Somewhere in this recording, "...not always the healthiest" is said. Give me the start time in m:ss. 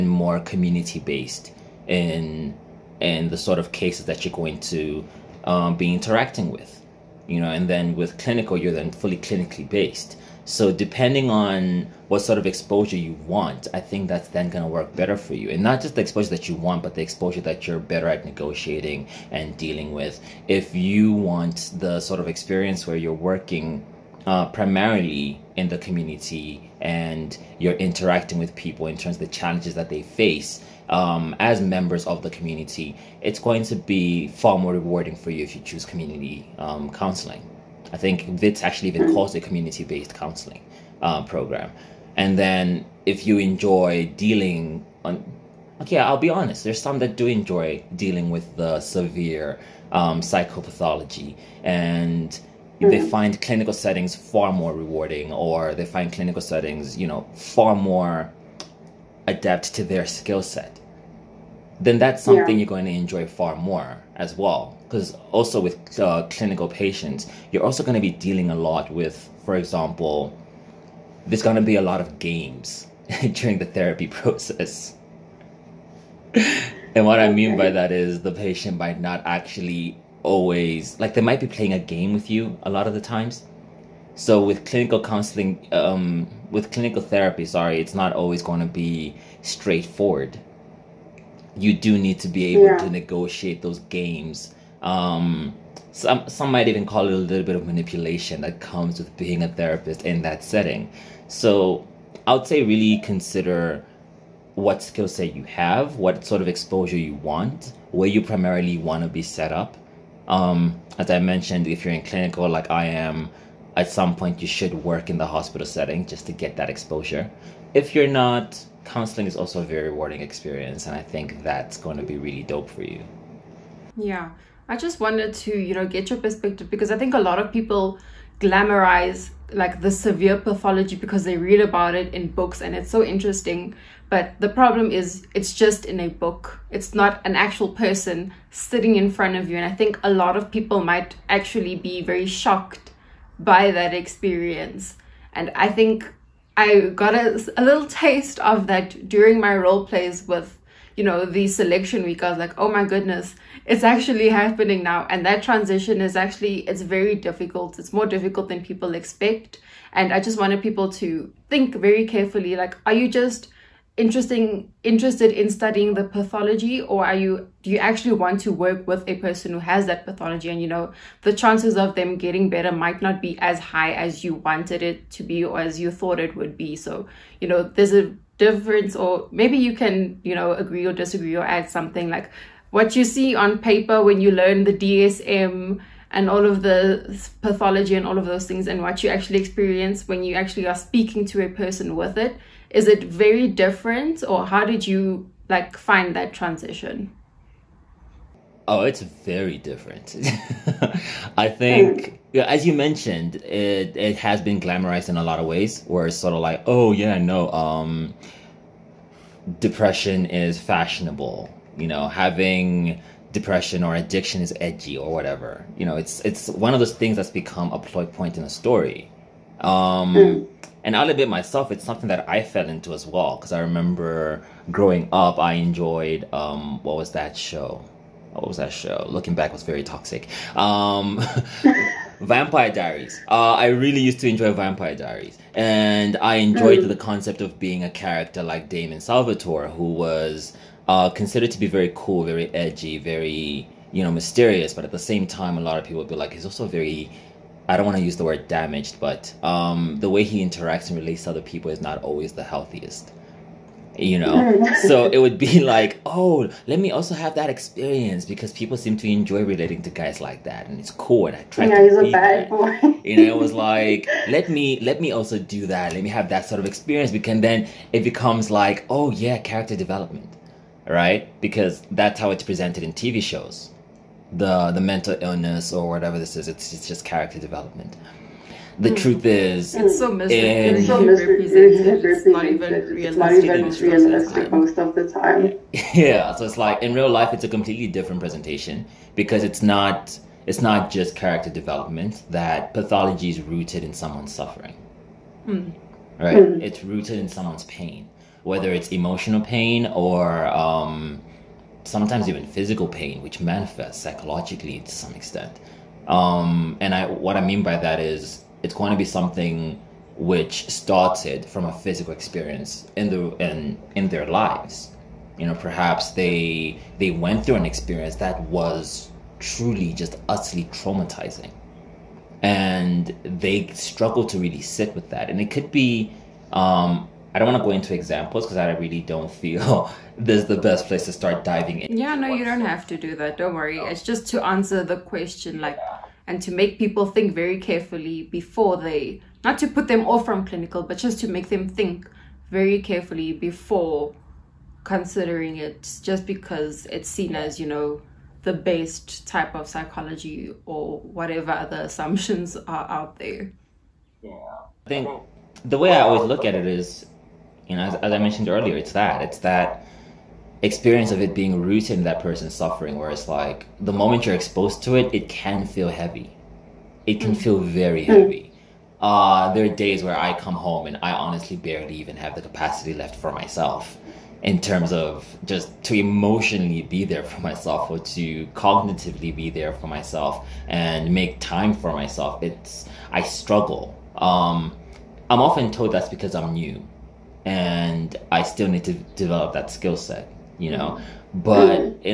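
4:11.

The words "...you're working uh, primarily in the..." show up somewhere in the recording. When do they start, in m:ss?
0:22.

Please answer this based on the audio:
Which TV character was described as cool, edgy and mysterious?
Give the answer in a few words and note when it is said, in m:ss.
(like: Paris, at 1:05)
Damon Salvatore, at 3:58.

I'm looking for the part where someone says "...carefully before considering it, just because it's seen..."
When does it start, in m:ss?
5:42.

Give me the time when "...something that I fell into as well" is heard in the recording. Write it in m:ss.
3:41.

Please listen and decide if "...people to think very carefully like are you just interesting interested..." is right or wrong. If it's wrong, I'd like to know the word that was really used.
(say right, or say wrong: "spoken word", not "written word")
right.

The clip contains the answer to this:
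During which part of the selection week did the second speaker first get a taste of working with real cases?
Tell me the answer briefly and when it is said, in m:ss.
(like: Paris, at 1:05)
Role plays, at 2:29.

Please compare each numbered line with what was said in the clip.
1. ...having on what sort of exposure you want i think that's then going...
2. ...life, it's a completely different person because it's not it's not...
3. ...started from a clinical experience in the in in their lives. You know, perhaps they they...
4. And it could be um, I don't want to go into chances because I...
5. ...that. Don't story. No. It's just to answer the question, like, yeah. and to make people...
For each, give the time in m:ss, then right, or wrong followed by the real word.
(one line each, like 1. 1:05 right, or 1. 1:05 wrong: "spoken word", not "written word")
1. 0:10 wrong: "depending", not "having"
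2. 4:47 wrong: "presentation", not "person"
3. 5:10 wrong: "physical", not "clinical"
4. 5:25 wrong: "examples", not "chances"
5. 5:33 wrong: "worry", not "story".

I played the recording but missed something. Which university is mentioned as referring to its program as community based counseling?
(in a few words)
Wits.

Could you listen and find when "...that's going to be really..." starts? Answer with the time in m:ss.
2:01.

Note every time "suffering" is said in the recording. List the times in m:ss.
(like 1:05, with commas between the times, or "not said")
4:54, 6:02.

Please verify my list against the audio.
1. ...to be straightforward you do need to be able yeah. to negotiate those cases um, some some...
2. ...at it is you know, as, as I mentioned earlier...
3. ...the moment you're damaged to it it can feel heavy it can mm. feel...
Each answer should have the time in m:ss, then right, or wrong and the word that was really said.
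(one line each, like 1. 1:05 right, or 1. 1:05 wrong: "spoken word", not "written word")
1. 1:28 wrong: "games", not "cases"
2. 5:56 right
3. 6:03 wrong: "exposed", not "damaged".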